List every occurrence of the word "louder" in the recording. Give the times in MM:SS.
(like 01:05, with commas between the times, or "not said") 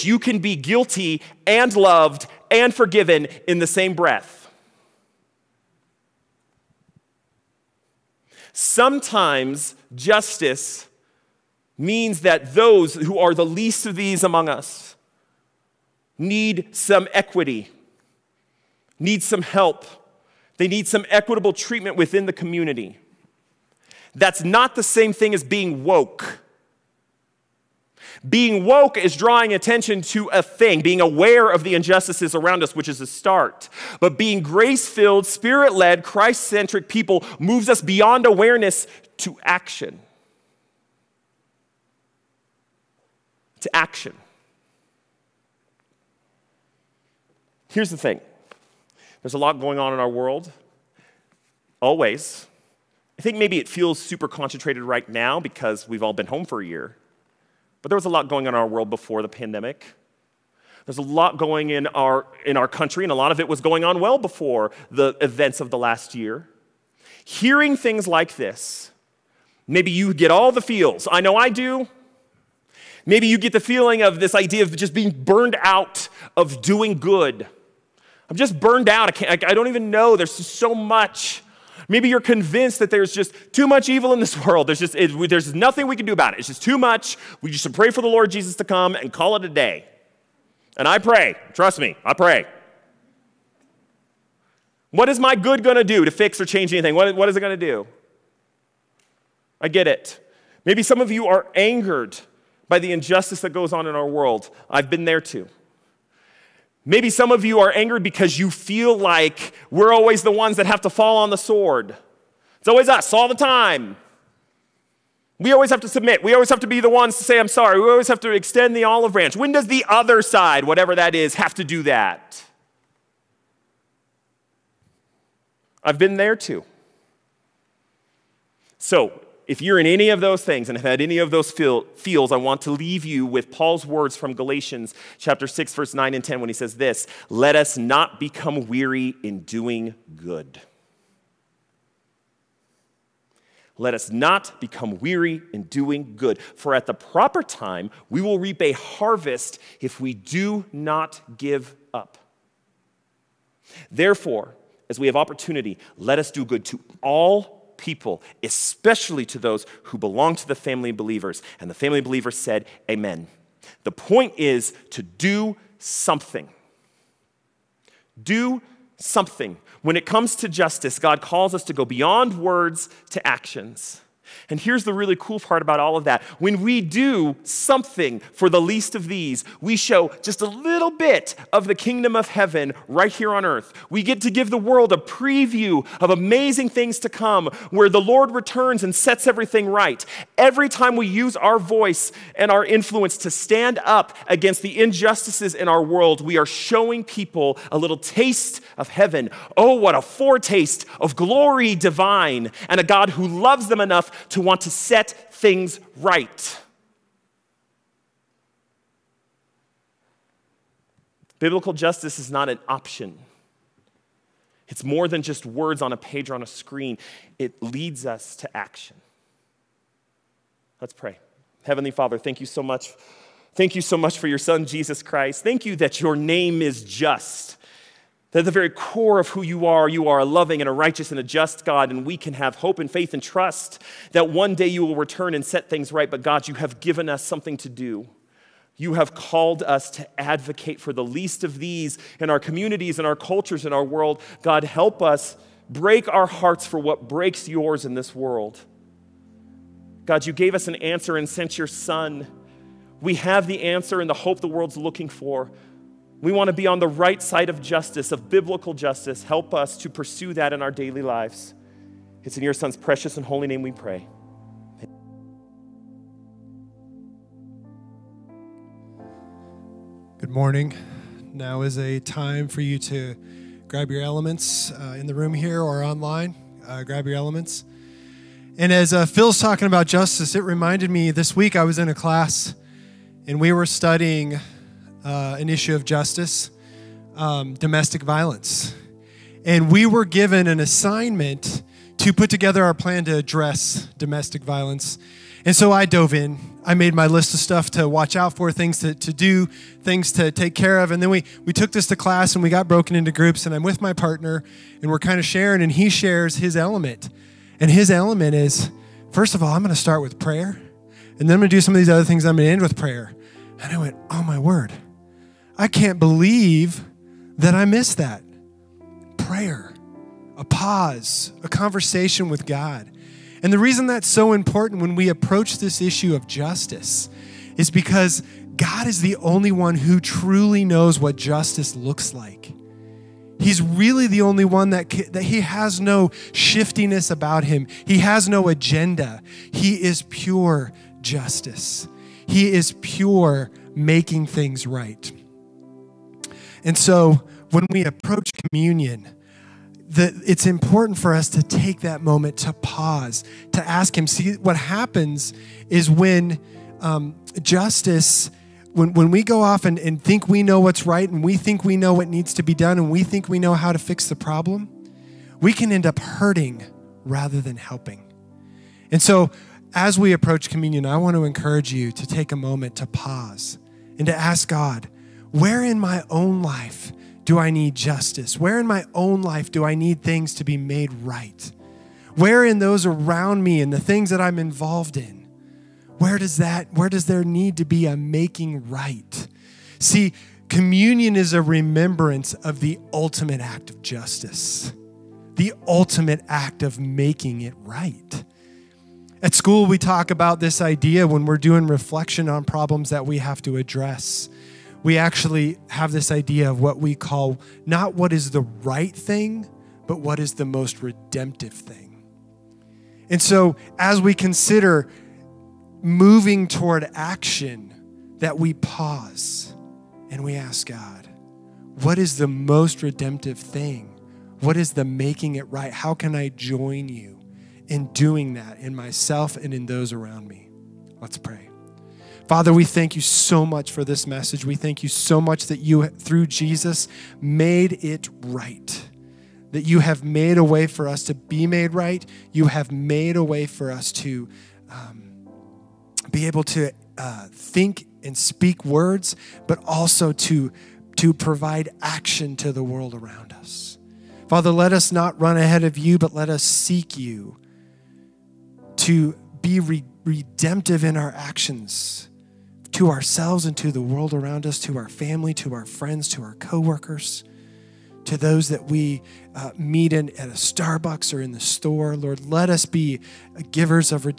not said.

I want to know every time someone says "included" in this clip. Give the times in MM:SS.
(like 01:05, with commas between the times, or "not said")
not said.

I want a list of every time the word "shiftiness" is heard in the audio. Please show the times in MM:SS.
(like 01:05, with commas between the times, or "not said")
05:36.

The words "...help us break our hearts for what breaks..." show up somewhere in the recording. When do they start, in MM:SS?
04:04.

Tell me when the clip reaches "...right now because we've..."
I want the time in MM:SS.
00:54.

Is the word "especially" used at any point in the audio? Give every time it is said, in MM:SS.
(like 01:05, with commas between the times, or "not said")
02:38.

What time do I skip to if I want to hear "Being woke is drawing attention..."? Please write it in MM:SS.
00:28.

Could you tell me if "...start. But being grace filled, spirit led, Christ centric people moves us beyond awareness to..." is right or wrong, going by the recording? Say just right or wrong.
right.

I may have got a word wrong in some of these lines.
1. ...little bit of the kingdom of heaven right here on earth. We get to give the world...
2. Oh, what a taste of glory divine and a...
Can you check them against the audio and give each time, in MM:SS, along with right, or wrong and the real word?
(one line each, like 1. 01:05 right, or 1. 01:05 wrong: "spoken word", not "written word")
1. 03:00 right
2. 03:19 wrong: "foretaste", not "taste".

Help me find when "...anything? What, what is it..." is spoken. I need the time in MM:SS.
01:36.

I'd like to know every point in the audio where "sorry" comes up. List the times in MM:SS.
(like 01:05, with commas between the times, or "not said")
01:57.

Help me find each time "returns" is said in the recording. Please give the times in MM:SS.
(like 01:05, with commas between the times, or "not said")
03:08, 03:54.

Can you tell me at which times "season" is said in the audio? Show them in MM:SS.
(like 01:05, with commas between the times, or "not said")
not said.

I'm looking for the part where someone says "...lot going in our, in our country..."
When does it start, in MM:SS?
01:01.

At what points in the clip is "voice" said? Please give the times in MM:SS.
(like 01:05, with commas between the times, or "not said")
03:11.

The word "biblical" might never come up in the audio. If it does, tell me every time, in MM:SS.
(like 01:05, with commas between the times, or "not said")
03:31, 04:18.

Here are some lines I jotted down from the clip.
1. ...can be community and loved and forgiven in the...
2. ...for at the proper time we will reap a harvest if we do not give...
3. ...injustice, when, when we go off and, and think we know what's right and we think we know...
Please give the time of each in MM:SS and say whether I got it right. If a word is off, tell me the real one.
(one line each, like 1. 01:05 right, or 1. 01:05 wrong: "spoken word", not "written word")
1. 00:00 wrong: "guilty", not "community"
2. 02:26 right
3. 05:57 wrong: "justice", not "injustice".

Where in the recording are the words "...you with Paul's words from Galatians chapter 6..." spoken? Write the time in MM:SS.
02:13.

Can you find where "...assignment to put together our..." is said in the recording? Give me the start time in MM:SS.
04:50.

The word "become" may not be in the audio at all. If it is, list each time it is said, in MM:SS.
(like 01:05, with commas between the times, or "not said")
02:18, 02:24.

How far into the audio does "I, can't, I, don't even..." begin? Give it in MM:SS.
01:19.